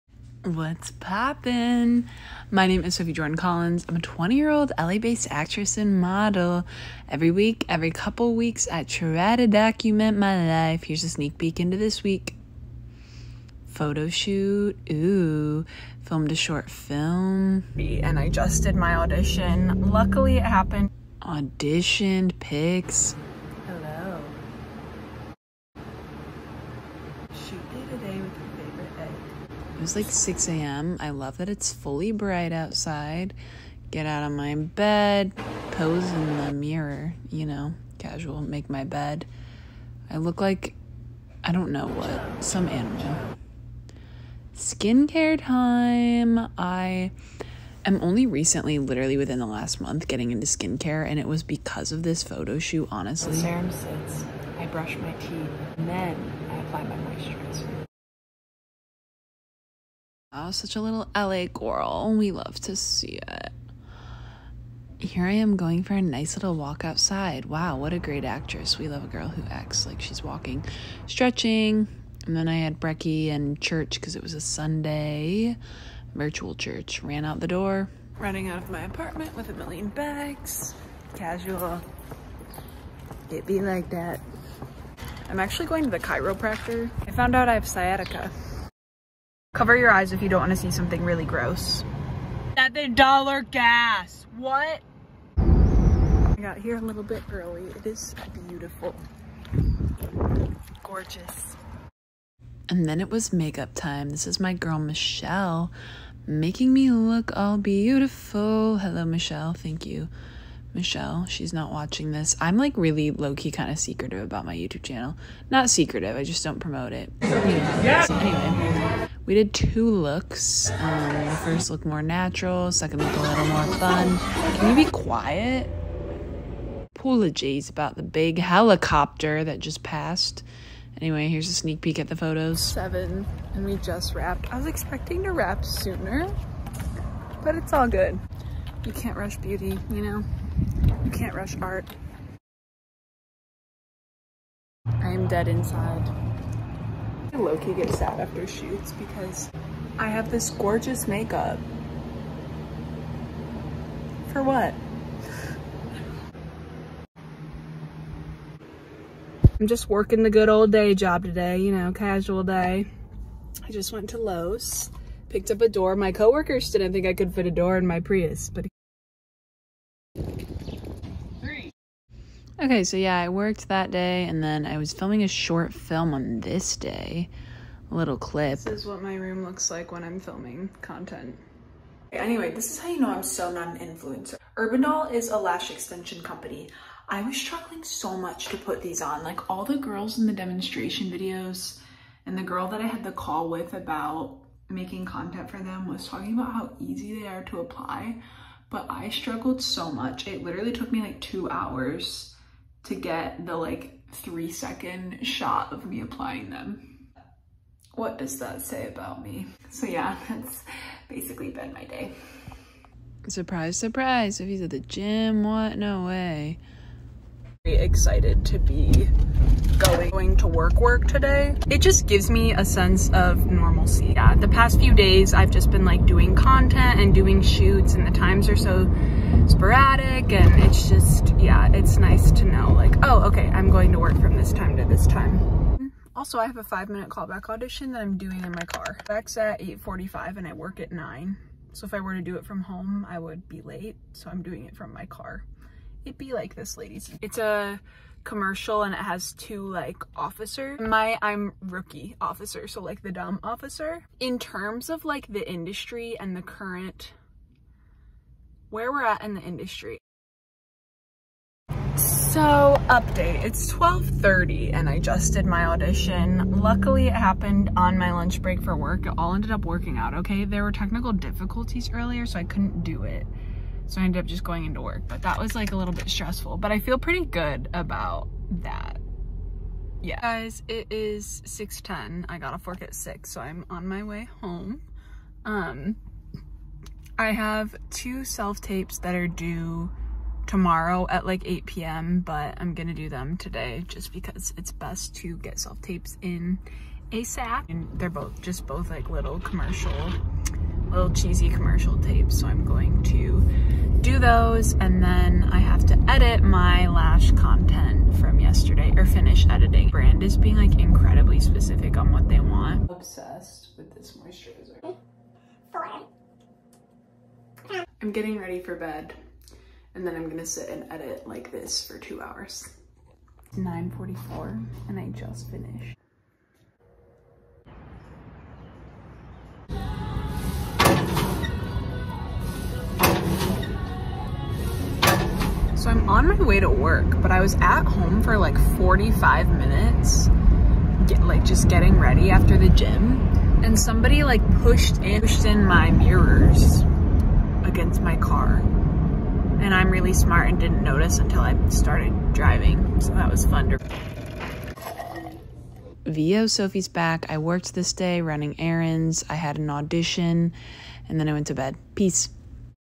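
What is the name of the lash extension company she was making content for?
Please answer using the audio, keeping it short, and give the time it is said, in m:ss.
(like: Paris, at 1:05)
Urbanol, at 3:04.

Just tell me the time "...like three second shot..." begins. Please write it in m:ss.
3:23.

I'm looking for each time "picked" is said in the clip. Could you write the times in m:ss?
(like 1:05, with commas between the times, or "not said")
2:45.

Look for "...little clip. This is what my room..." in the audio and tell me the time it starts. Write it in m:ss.
2:57.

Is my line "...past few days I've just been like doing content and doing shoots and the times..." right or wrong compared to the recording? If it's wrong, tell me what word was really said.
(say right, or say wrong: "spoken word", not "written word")
right.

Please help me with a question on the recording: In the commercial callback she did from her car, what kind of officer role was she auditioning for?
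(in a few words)
rookie officer.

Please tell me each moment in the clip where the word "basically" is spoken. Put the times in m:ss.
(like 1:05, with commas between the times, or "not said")
3:31.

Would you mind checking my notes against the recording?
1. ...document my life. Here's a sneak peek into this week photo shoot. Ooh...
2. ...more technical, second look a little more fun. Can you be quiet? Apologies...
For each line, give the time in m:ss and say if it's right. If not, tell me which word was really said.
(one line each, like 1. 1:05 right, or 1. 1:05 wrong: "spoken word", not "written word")
1. 0:09 right
2. 2:01 wrong: "natural", not "technical".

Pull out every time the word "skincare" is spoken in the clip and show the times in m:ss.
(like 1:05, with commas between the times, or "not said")
0:44, 0:50.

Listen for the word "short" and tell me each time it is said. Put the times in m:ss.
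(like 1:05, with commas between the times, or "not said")
0:16, 2:55.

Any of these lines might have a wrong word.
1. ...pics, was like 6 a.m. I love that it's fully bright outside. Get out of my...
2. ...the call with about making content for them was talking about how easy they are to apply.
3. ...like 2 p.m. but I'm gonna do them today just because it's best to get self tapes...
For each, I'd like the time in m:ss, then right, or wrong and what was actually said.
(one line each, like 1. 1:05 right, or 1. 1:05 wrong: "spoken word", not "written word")
1. 0:22 right
2. 3:13 right
3. 4:51 wrong: "8", not "2".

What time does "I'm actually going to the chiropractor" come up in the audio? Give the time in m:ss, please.
1:25.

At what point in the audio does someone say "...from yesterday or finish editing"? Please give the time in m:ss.
5:08.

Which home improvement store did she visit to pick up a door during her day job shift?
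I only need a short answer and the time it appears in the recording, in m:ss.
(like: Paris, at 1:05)
Lowe's, at 2:44.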